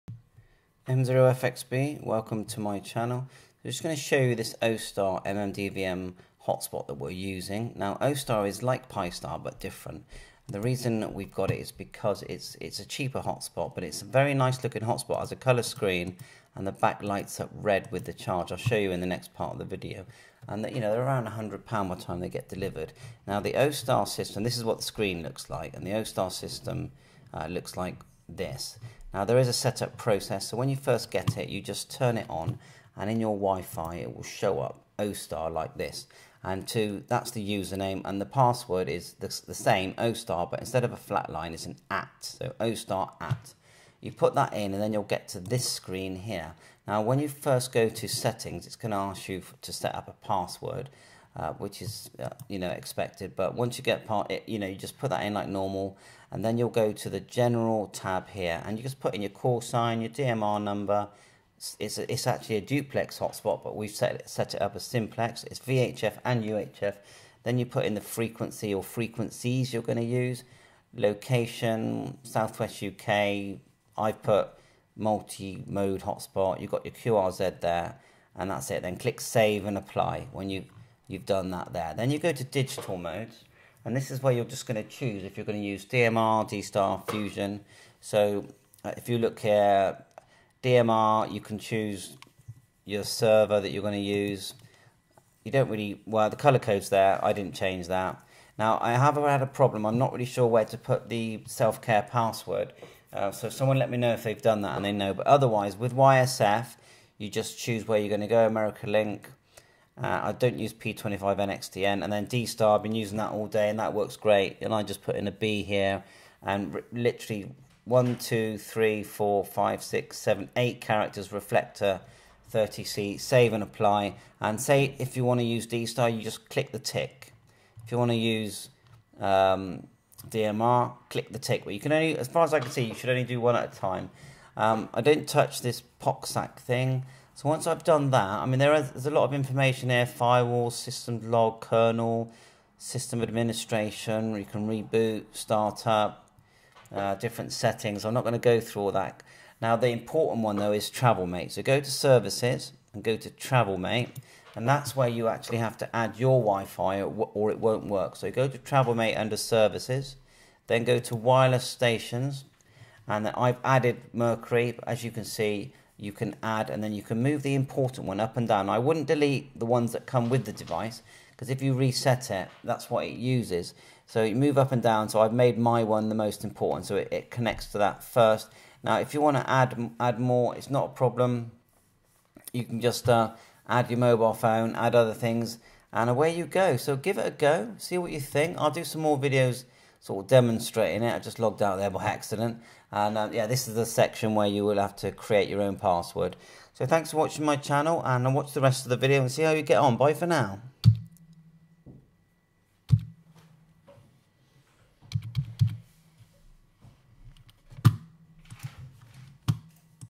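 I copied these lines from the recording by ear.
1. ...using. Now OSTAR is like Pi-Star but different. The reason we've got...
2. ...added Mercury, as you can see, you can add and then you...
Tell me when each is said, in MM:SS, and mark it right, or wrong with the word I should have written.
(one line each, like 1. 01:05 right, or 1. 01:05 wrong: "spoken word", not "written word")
1. 00:07 right
2. 02:43 right.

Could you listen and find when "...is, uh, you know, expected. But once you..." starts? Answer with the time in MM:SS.
00:51.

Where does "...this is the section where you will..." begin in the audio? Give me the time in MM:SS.
03:13.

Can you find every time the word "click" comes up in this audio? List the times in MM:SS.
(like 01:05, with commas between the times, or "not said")
01:18, 02:06, 02:11.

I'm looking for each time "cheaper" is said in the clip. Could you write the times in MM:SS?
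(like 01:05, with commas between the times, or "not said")
00:12.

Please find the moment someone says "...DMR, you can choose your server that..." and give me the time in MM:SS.
01:30.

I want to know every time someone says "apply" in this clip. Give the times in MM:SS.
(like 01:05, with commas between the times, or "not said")
01:19, 02:03.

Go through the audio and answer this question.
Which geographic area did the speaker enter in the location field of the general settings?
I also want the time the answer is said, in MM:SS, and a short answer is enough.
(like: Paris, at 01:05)
Southwest UK, at 01:12.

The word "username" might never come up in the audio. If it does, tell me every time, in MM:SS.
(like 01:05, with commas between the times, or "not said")
00:37.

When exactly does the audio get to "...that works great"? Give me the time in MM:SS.
01:53.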